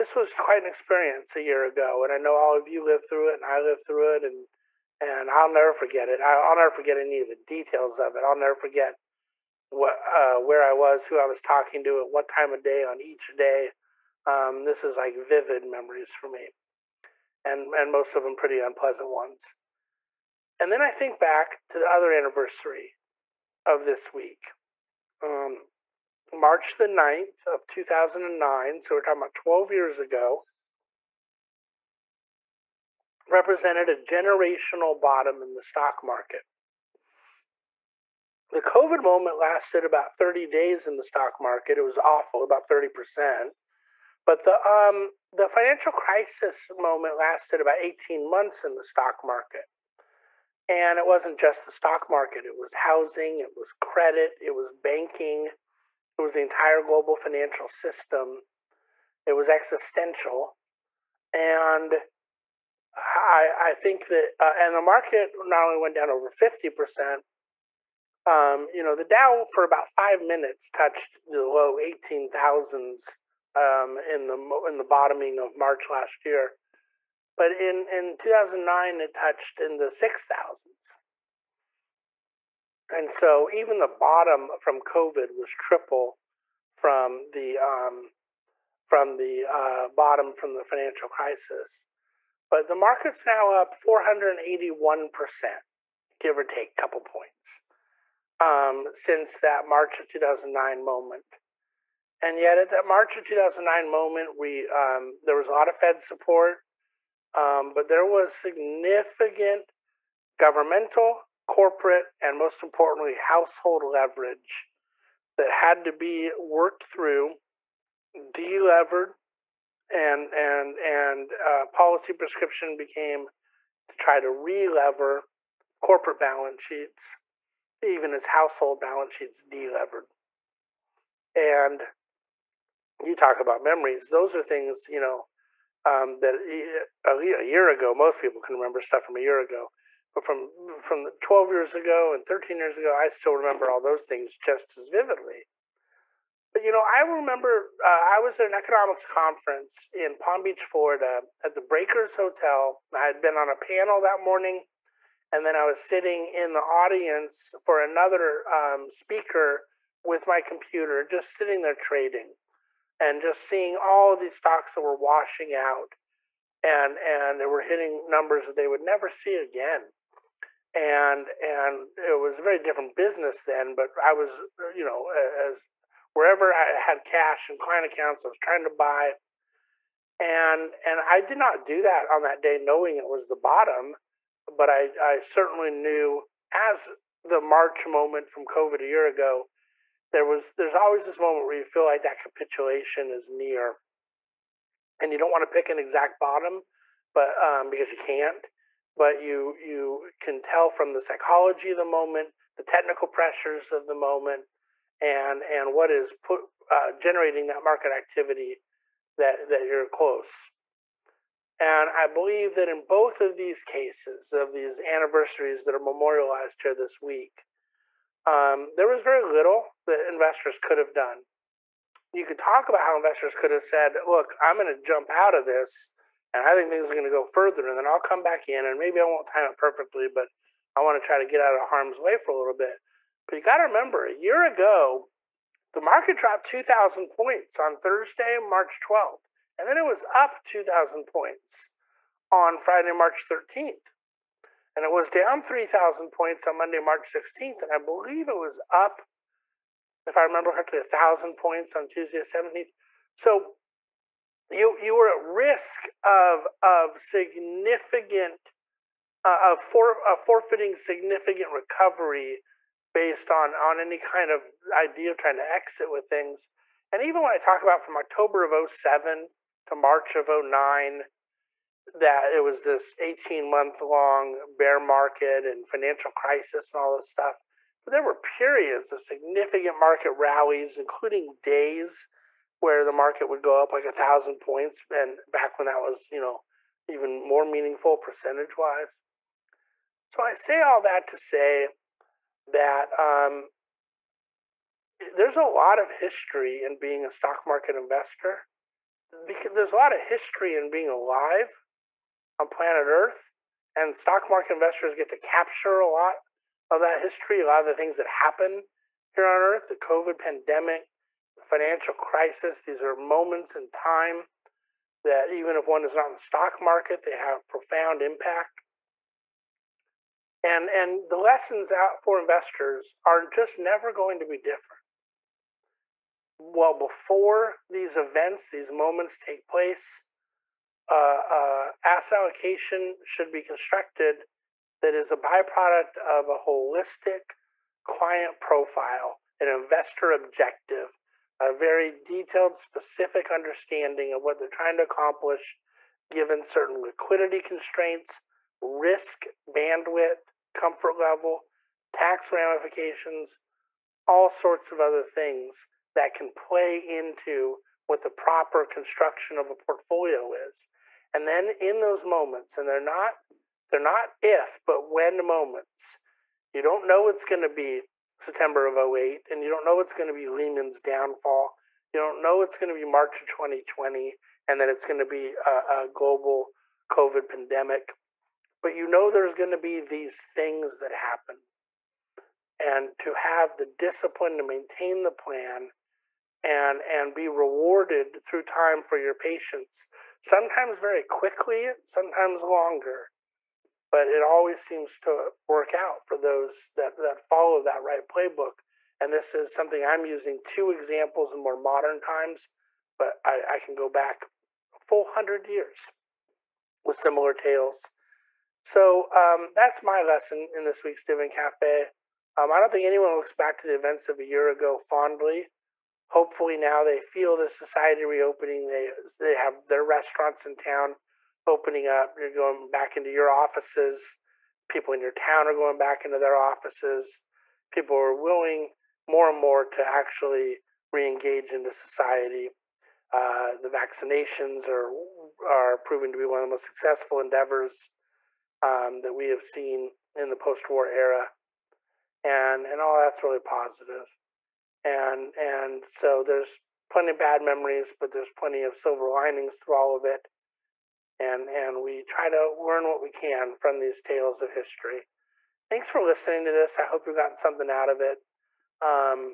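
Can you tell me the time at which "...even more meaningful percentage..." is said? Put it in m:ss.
4:46.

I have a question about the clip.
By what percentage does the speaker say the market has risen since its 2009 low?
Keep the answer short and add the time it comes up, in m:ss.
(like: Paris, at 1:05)
481%, at 1:33.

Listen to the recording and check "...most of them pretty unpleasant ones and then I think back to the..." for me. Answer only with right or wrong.
right.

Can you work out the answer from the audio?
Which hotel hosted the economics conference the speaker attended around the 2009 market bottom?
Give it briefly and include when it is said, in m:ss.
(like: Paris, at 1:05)
The Breakers Hotel, at 2:31.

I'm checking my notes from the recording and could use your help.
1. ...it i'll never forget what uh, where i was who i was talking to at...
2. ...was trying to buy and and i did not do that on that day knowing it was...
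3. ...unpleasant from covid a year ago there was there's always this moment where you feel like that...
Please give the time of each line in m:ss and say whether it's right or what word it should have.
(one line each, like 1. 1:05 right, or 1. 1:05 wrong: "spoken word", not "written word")
1. 0:08 right
2. 2:58 right
3. 3:07 wrong: "moment", not "unpleasant".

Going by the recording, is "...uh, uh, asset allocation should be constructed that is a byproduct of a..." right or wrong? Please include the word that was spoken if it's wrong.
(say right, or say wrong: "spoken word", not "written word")
right.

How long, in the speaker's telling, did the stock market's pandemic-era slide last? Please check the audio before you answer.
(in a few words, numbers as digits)
about 30 days.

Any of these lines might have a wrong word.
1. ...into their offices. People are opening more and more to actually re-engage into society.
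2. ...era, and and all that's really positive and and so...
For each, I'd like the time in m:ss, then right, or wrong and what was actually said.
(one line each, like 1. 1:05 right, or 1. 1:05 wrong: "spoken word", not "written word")
1. 7:06 wrong: "willing", not "opening"
2. 7:20 right.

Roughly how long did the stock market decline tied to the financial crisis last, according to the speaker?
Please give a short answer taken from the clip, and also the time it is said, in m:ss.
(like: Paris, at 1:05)
18 months, at 0:47.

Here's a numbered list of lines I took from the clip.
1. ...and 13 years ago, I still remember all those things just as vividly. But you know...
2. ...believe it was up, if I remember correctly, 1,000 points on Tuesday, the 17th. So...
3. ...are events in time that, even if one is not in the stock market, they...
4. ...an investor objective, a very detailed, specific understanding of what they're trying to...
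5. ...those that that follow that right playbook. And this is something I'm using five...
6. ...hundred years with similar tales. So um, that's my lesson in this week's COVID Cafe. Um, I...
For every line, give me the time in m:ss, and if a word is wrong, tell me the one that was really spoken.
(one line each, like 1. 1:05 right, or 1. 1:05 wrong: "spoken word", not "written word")
1. 2:22 right
2. 4:07 right
3. 5:12 wrong: "moments", not "events"
4. 5:39 right
5. 6:36 wrong: "two", not "five"
6. 6:45 wrong: "Dividend", not "COVID".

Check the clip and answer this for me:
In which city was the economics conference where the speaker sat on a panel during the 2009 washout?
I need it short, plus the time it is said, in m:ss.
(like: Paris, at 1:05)
Palm Beach, Florida, at 2:30.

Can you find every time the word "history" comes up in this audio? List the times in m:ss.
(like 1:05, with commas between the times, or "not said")
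4:55, 5:00, 5:06, 7:34.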